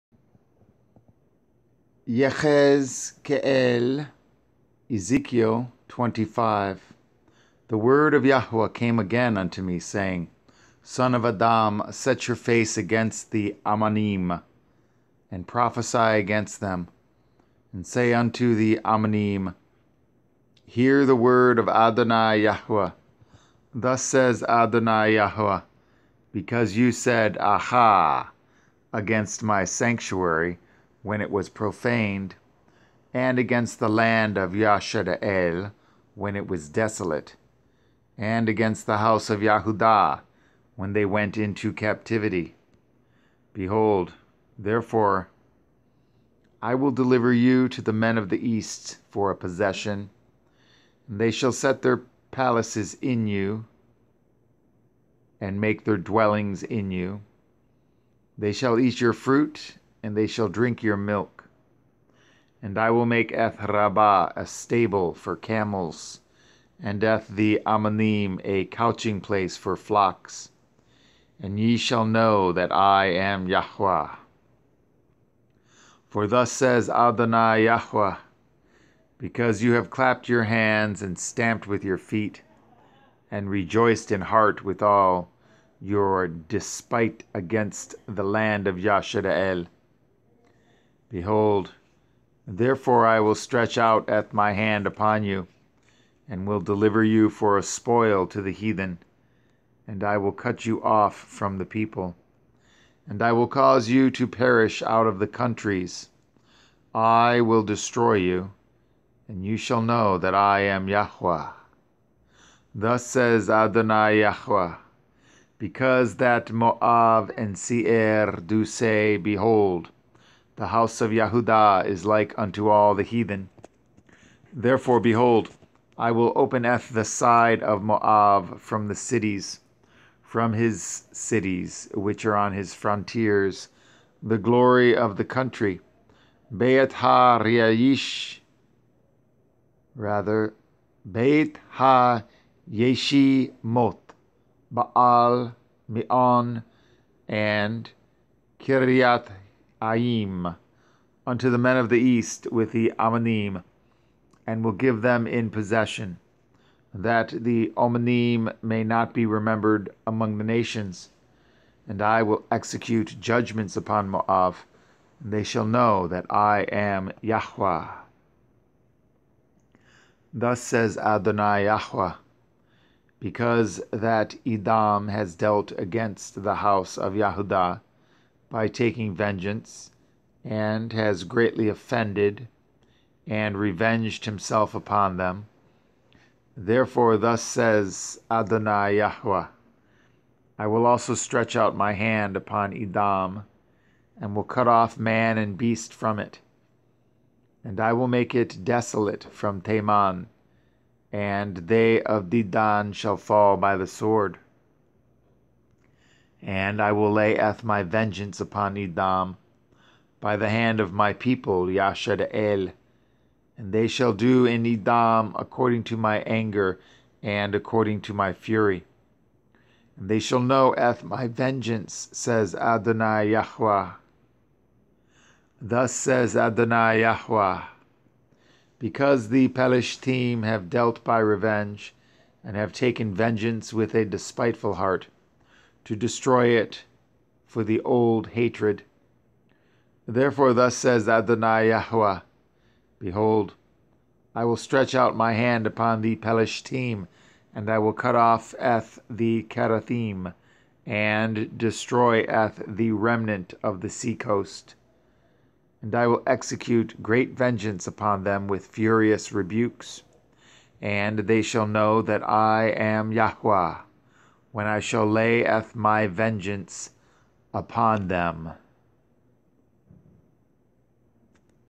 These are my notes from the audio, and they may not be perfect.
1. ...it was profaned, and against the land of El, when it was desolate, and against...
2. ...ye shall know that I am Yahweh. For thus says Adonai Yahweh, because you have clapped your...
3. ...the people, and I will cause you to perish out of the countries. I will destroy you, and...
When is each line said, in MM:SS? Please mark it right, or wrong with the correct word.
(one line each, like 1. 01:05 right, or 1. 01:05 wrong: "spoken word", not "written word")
1. 00:31 right
2. 01:11 right
3. 01:41 right.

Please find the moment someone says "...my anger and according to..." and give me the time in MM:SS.
03:35.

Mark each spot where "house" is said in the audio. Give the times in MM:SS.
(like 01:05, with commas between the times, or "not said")
00:38, 02:00, 02:56.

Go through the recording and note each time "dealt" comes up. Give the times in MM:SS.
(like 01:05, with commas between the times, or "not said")
02:55, 03:50.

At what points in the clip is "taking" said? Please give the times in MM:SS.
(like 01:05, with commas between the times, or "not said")
02:58.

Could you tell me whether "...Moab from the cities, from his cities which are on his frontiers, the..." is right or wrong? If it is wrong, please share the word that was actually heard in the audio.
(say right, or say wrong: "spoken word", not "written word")
right.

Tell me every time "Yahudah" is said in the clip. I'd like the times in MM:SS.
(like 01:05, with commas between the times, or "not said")
00:39, 02:57.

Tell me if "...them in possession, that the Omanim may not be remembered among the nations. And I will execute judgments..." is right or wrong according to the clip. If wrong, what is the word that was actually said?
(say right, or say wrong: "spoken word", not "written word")
right.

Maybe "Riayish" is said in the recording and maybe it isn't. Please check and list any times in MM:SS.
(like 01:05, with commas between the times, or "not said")
02:16.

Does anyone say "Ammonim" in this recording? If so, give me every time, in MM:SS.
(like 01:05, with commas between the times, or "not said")
00:13, 00:18, 01:07, 02:32.